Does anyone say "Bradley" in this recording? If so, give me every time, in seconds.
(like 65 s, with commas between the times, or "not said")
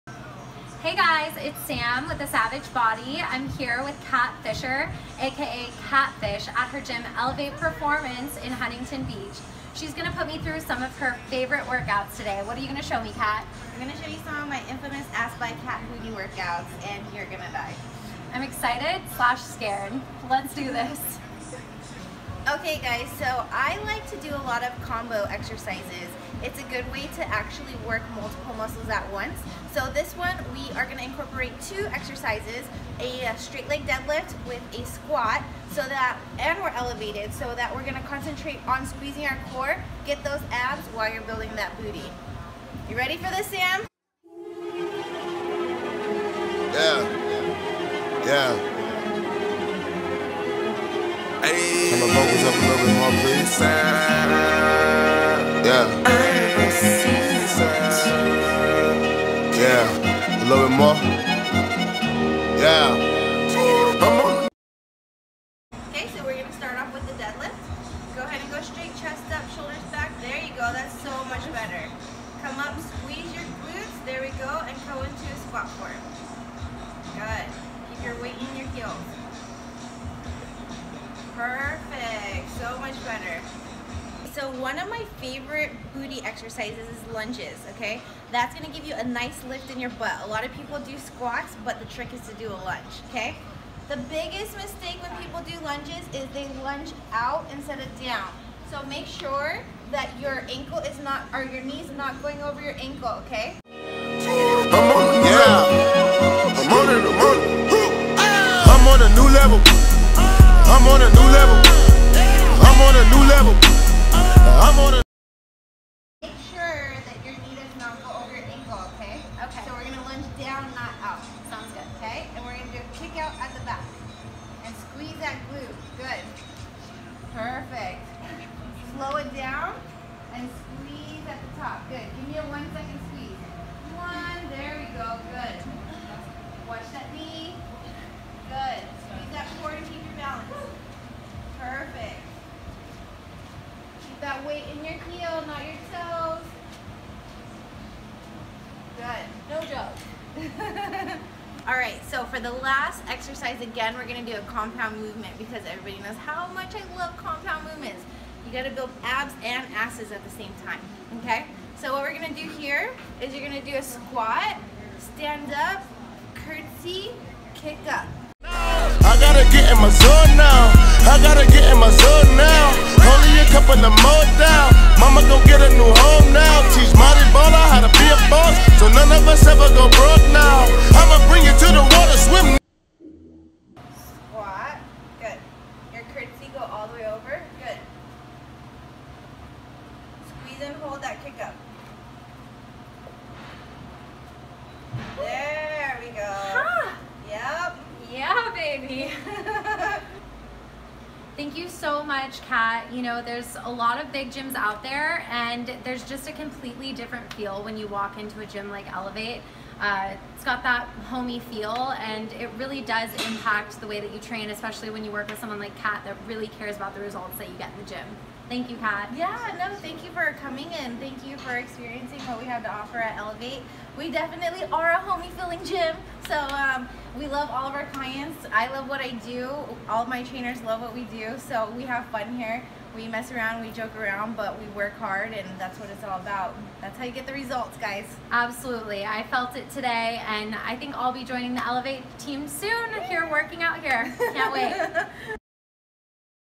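not said.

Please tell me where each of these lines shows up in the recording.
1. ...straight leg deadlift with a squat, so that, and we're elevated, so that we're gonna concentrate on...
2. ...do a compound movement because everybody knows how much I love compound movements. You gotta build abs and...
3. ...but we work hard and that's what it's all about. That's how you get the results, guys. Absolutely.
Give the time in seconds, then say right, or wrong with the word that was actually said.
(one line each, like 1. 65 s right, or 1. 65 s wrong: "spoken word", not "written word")
1. 33 s right
2. 154 s right
3. 234 s right.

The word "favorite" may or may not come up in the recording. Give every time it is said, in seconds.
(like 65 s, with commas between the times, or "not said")
11 s, 85 s.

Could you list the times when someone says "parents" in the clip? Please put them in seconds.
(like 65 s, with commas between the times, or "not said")
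not said.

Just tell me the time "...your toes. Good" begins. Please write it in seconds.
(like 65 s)
145 s.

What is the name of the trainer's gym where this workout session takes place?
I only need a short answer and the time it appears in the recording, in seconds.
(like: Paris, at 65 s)
Elev8 Performance, at 7 s.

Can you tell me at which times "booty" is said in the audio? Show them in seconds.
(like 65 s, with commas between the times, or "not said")
41 s, 85 s.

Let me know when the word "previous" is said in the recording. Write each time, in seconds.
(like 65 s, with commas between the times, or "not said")
not said.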